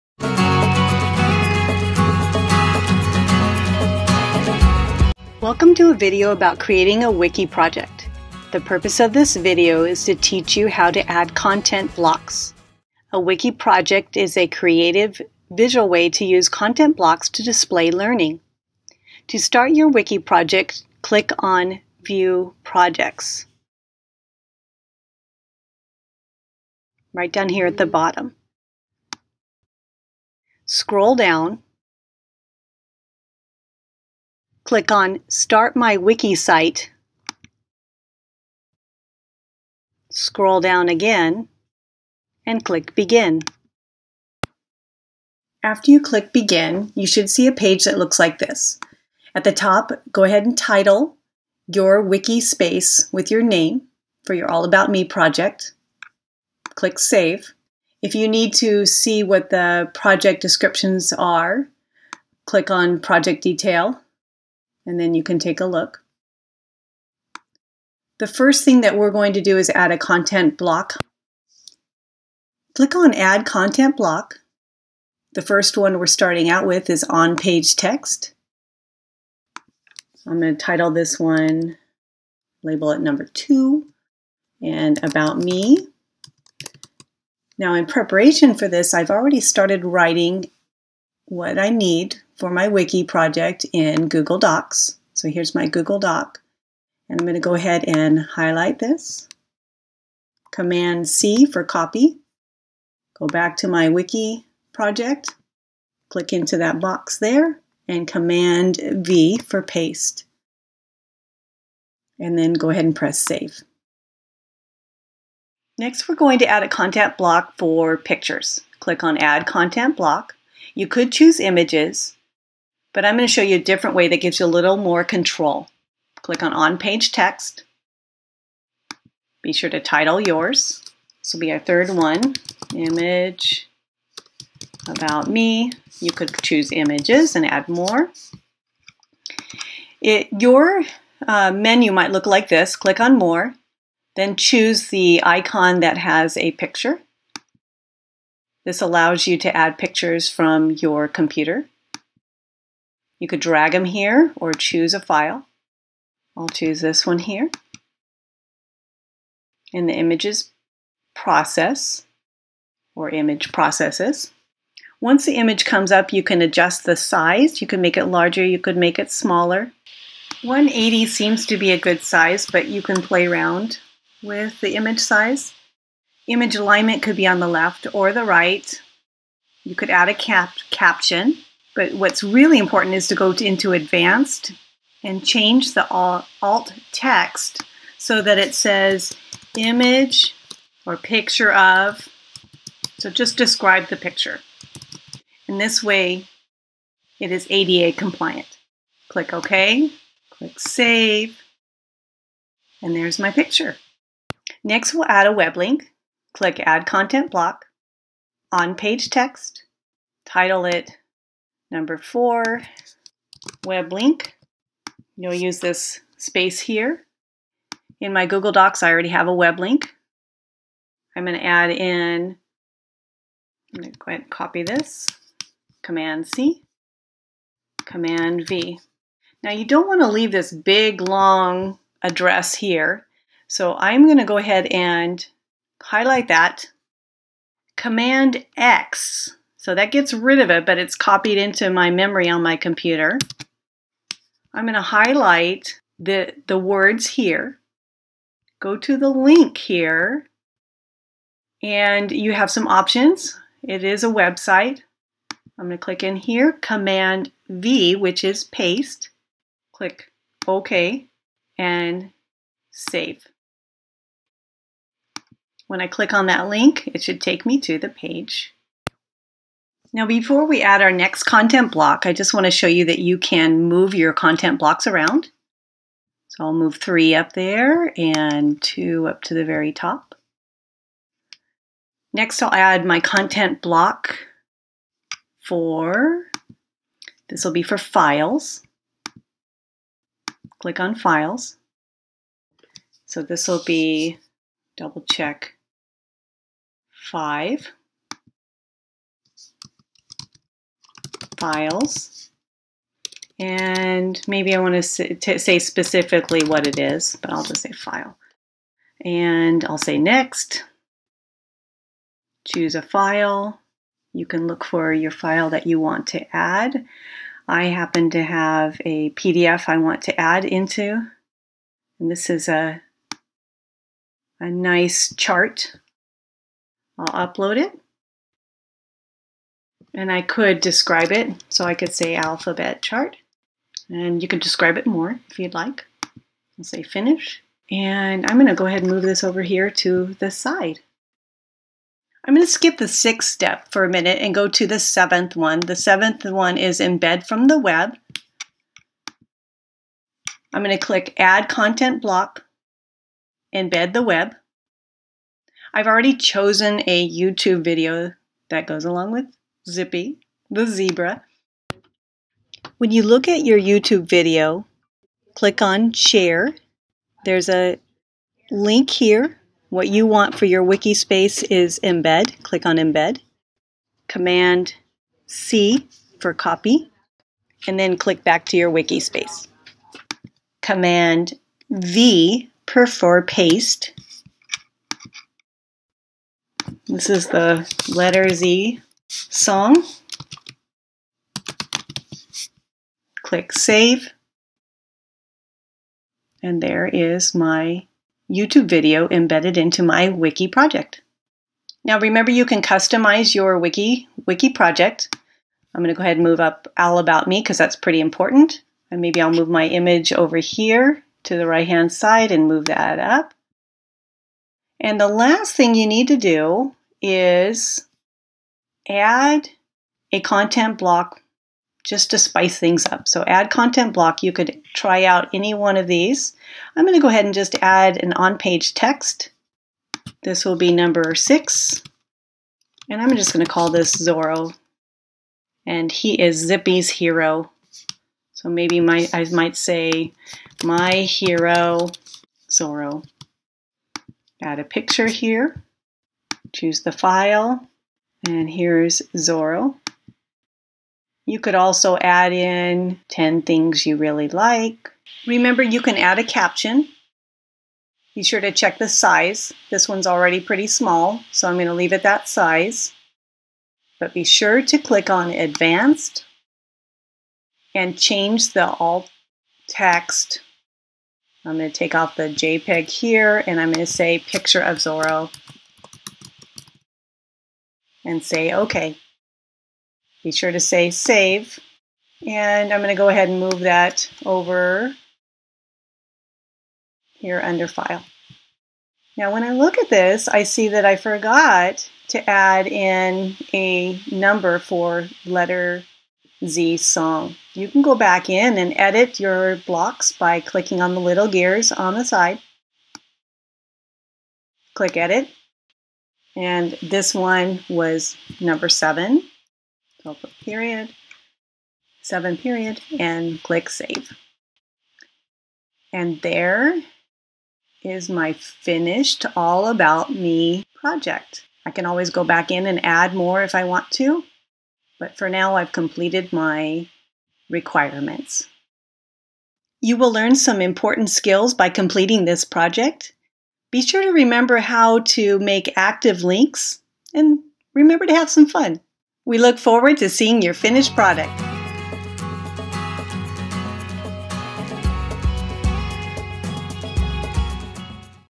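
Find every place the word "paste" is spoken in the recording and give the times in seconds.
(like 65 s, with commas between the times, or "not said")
109 s, 258 s, 383 s.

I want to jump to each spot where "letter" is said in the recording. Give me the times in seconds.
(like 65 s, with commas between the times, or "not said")
387 s, 495 s.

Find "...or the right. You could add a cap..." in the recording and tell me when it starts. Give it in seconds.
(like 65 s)
177 s.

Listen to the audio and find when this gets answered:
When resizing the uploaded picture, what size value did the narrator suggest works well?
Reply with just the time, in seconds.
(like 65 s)
170 s.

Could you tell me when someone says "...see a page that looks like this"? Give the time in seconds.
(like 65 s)
47 s.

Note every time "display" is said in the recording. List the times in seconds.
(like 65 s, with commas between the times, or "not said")
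17 s.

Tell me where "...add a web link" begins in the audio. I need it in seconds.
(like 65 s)
205 s.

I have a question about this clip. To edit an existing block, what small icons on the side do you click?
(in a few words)
gears.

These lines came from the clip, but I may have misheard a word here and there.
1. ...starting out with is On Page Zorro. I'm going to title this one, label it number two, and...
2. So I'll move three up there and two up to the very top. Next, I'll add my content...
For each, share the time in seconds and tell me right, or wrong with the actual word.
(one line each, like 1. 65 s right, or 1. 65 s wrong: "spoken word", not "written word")
1. 76 s wrong: "Text", not "Zorro"
2. 276 s right.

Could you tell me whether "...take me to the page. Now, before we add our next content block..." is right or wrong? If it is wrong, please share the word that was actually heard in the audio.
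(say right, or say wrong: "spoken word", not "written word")
right.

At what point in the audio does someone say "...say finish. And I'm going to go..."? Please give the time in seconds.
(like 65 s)
336 s.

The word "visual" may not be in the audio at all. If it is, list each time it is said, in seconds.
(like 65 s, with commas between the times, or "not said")
15 s.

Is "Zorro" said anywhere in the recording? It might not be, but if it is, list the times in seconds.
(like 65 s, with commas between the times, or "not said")
433 s, 442 s, 449 s, 474 s.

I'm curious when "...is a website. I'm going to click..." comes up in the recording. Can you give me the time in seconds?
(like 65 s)
253 s.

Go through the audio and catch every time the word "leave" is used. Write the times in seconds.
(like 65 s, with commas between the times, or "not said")
230 s, 461 s.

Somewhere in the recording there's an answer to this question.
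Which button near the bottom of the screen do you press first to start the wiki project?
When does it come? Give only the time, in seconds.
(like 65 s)
22 s.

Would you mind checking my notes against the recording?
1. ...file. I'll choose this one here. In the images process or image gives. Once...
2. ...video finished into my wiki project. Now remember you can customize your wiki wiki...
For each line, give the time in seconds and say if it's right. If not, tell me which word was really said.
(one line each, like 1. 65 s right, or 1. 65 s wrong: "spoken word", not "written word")
1. 154 s wrong: "processes", not "gives"
2. 398 s wrong: "embedded", not "finished".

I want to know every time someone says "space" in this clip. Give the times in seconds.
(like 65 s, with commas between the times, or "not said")
52 s, 216 s, 370 s, 378 s.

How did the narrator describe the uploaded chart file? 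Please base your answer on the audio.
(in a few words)
alphabet chart.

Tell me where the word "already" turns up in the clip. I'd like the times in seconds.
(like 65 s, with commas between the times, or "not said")
89 s, 218 s, 355 s, 460 s.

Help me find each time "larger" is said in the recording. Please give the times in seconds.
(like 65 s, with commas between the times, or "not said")
168 s.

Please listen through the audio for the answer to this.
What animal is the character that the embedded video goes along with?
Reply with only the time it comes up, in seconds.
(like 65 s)
360 s.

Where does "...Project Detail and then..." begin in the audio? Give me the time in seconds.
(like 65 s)
63 s.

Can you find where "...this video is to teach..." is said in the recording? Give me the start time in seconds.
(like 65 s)
9 s.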